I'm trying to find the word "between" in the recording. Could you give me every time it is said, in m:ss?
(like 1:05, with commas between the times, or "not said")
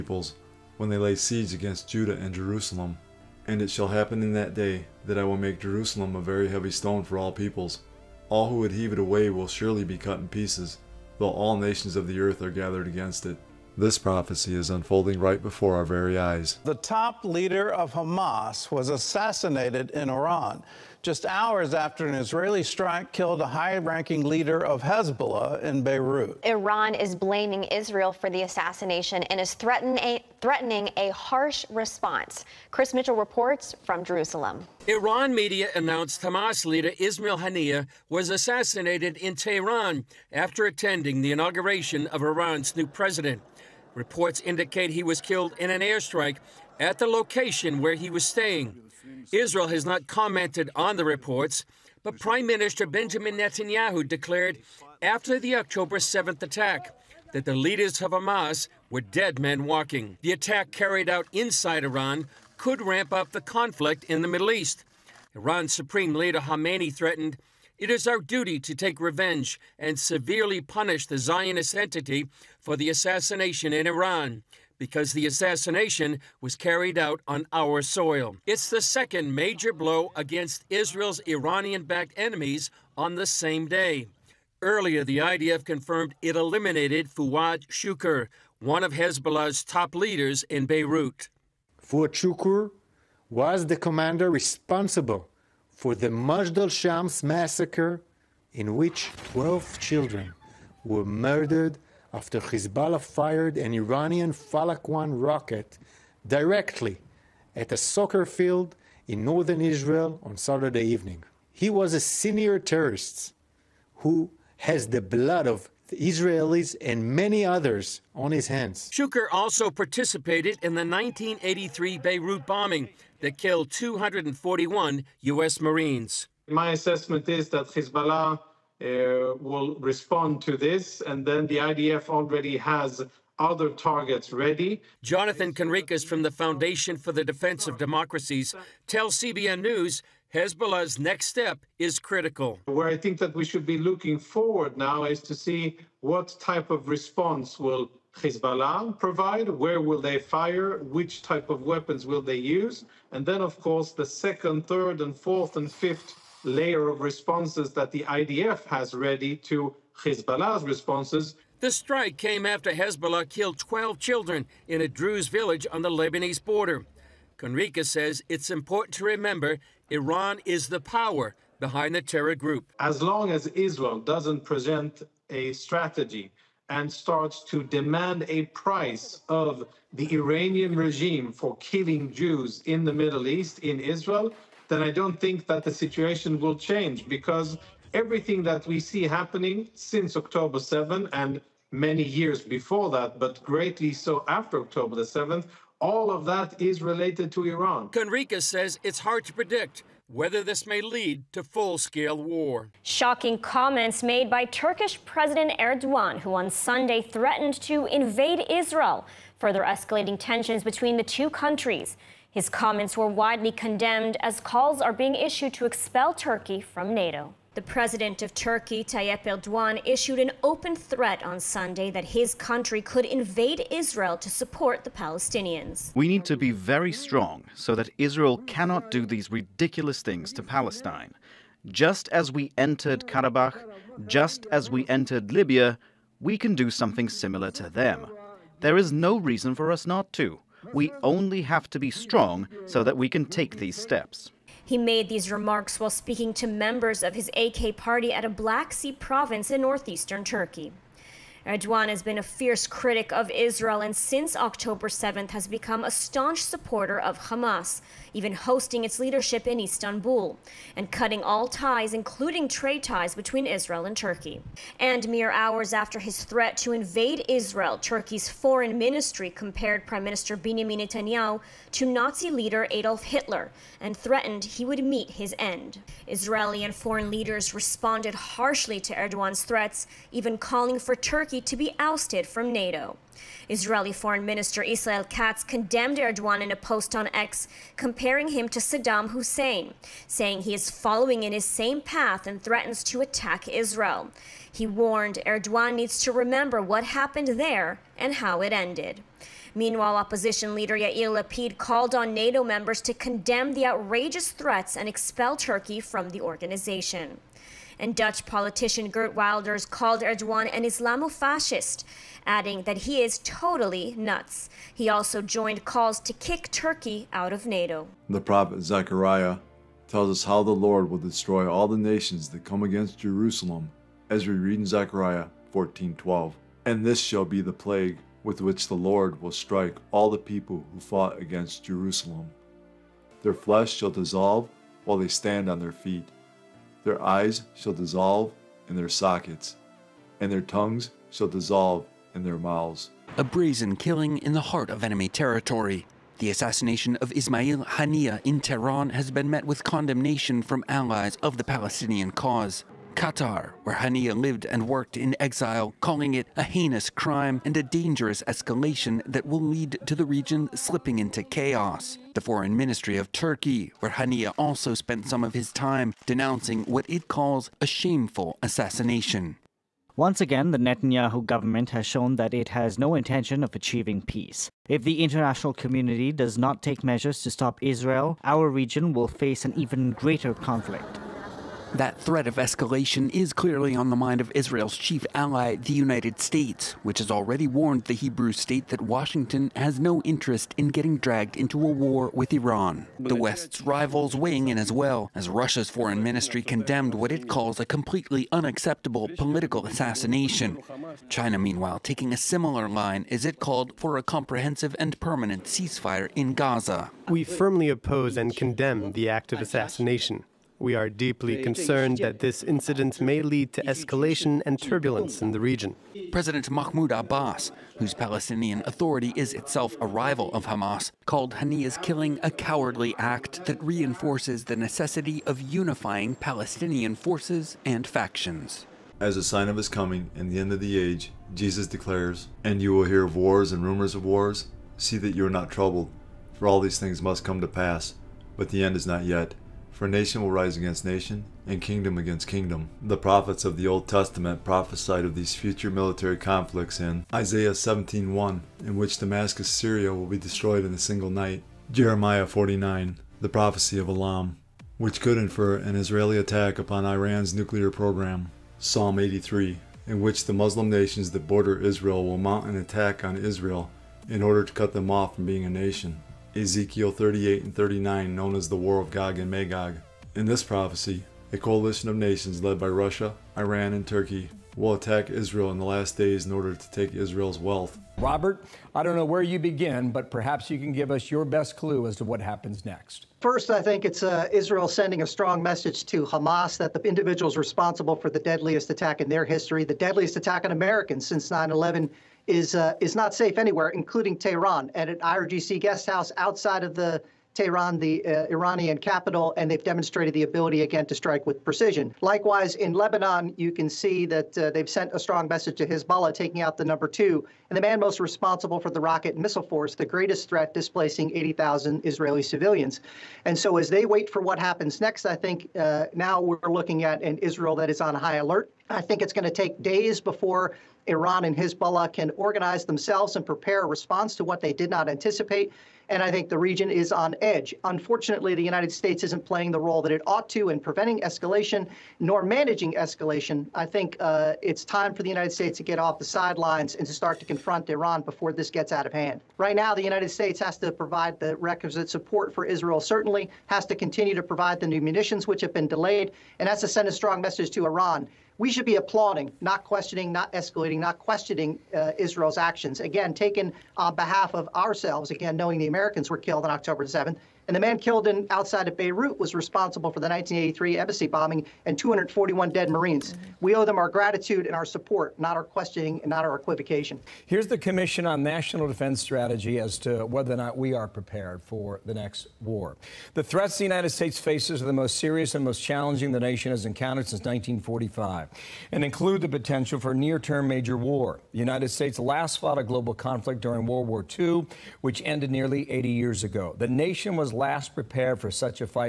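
3:30, 4:23.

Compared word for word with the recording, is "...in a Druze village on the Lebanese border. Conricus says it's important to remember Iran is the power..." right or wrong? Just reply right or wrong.
right.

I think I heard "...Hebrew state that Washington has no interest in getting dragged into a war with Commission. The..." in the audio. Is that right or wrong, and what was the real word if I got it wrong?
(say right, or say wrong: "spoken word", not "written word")
wrong: "Iran", not "Commission".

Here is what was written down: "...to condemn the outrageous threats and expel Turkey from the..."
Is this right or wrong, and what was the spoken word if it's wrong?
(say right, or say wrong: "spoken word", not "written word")
right.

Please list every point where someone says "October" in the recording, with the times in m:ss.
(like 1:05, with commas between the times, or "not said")
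0:55, 3:10, 3:14, 4:14, 9:16.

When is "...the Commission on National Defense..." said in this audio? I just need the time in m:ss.
9:27.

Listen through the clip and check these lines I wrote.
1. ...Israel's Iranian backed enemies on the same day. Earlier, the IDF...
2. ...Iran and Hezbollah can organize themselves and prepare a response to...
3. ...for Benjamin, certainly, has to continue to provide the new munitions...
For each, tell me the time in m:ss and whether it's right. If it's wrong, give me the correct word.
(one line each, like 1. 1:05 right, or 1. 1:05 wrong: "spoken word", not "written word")
1. 1:20 right
2. 8:40 right
3. 9:02 wrong: "Israel", not "Benjamin".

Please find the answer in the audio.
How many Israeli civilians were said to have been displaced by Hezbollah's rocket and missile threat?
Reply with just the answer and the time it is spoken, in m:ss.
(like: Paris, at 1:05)
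80,000, at 8:31.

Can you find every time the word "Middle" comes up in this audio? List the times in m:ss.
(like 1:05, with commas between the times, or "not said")
1:04, 3:02.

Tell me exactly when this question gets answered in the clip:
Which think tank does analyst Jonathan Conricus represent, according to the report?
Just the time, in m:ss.
2:16.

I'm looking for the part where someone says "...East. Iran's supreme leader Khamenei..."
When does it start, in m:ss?
1:04.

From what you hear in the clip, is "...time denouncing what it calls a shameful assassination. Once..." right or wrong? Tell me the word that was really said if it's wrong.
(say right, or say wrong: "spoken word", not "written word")
right.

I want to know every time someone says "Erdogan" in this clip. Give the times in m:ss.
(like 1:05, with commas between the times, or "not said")
3:25, 3:39, 4:11, 4:38, 4:45, 4:55, 5:10.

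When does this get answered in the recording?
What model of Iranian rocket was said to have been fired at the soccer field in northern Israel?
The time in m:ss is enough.
1:44.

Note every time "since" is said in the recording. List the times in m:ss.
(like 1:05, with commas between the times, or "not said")
3:09, 4:13, 8:11, 9:37.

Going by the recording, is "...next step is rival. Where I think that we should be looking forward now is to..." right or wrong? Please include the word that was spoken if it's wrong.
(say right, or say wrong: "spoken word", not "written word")
wrong: "critical", not "rival".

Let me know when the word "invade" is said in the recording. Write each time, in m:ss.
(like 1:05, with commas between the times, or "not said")
3:27, 3:43, 4:26.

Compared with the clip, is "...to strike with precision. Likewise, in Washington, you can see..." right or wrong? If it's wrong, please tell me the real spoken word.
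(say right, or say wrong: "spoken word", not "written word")
wrong: "Lebanon", not "Washington".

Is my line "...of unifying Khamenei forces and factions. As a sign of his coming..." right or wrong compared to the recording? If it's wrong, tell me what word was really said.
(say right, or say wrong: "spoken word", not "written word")
wrong: "Palestinian", not "Khamenei".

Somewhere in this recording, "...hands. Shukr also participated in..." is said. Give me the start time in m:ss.
1:58.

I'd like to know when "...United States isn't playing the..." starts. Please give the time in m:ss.
8:48.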